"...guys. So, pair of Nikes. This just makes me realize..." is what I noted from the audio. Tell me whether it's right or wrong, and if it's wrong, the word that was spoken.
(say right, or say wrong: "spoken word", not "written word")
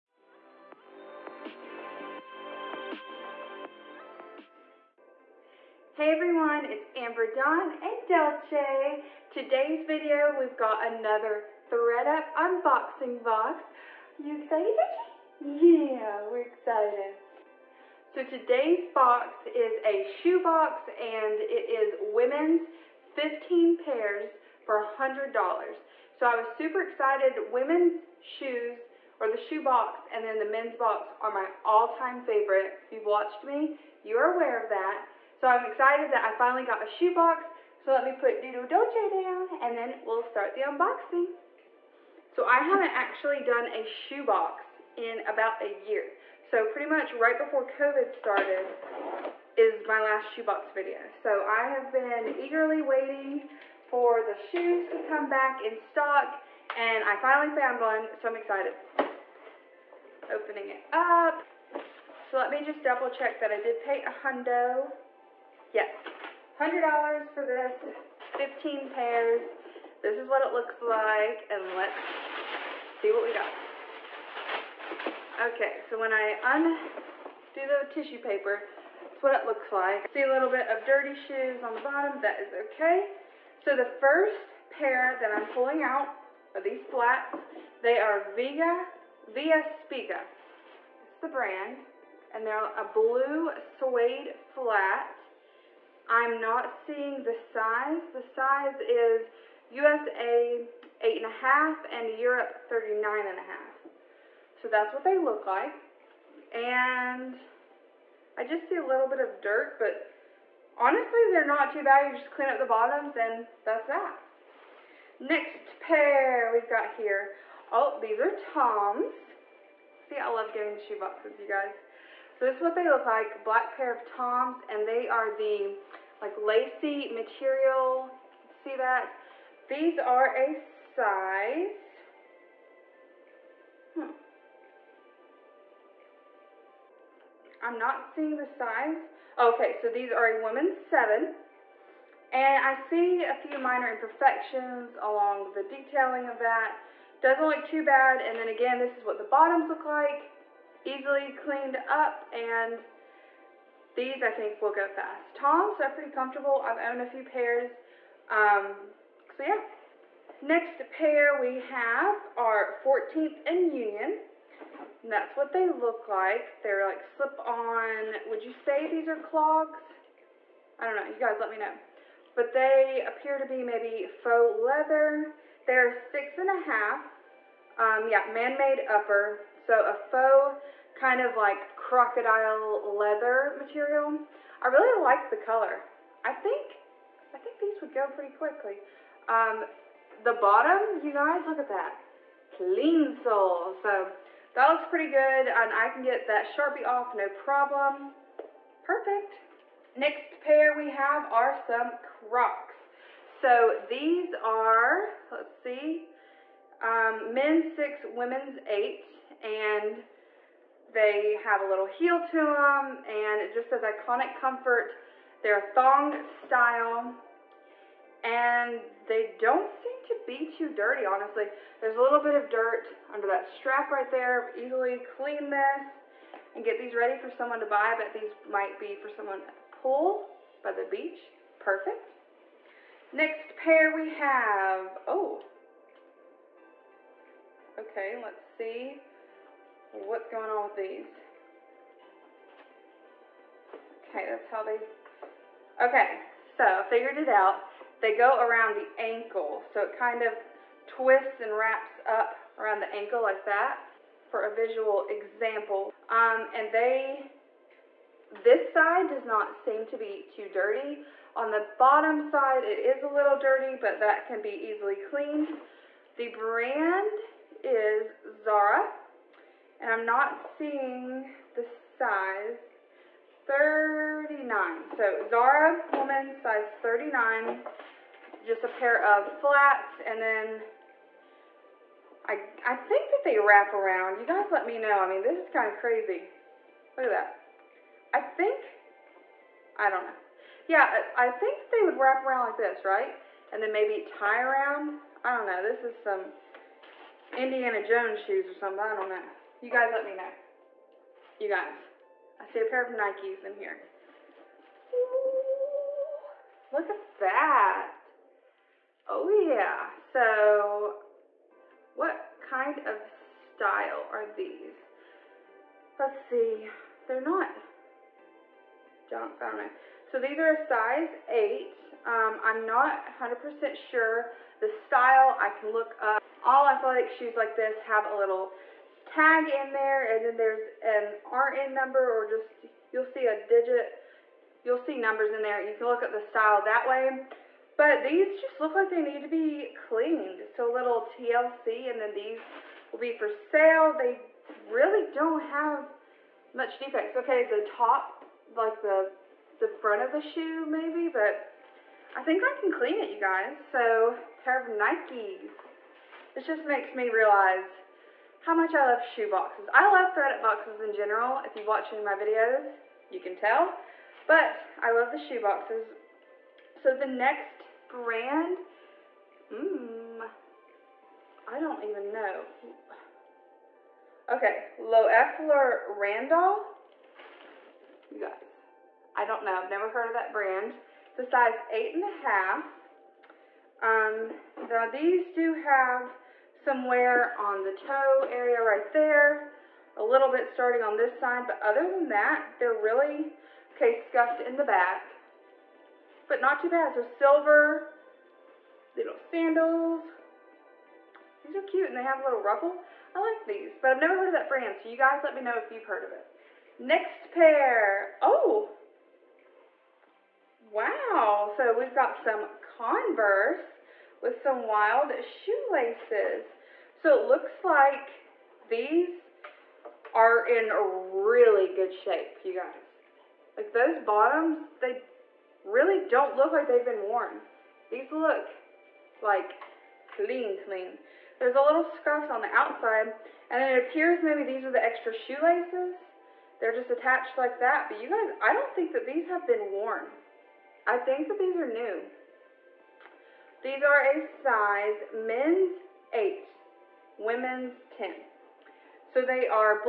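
right.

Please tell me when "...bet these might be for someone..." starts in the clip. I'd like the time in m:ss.
3:47.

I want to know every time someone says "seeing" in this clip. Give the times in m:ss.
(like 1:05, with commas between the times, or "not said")
1:36, 2:18, 4:30.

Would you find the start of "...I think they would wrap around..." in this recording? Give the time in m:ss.
4:51.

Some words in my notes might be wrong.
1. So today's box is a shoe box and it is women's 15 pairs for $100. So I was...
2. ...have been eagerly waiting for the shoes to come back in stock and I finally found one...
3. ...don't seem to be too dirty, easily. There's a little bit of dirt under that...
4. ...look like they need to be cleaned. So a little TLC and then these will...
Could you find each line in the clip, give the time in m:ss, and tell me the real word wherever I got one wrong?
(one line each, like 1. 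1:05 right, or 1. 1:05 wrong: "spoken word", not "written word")
1. 0:18 right
2. 0:51 right
3. 3:39 wrong: "honestly", not "easily"
4. 5:38 right.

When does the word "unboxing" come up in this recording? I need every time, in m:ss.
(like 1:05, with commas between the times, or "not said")
0:12, 0:40.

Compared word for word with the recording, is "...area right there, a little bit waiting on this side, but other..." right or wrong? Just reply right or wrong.
wrong.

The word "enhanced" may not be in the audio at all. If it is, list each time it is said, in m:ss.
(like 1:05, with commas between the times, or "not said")
not said.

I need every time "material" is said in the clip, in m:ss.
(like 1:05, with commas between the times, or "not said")
2:07, 3:03.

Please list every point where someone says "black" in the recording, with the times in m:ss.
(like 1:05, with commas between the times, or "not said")
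2:03.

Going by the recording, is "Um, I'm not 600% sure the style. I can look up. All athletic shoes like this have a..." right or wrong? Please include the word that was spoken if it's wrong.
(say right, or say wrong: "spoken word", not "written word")
wrong: "100", not "600".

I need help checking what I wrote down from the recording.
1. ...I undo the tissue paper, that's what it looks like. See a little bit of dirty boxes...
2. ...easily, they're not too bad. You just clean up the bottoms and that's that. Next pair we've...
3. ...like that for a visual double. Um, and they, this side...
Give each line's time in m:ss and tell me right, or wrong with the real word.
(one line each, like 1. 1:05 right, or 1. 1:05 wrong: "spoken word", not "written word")
1. 1:16 wrong: "shoes", not "boxes"
2. 1:50 wrong: "honestly", not "easily"
3. 4:13 wrong: "example", not "double".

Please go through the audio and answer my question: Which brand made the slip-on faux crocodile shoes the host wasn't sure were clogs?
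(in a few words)
14th and Union.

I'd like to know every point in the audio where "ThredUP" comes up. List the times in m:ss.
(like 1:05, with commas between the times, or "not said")
0:11, 6:00.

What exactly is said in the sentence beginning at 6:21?
It's a size eight and a half.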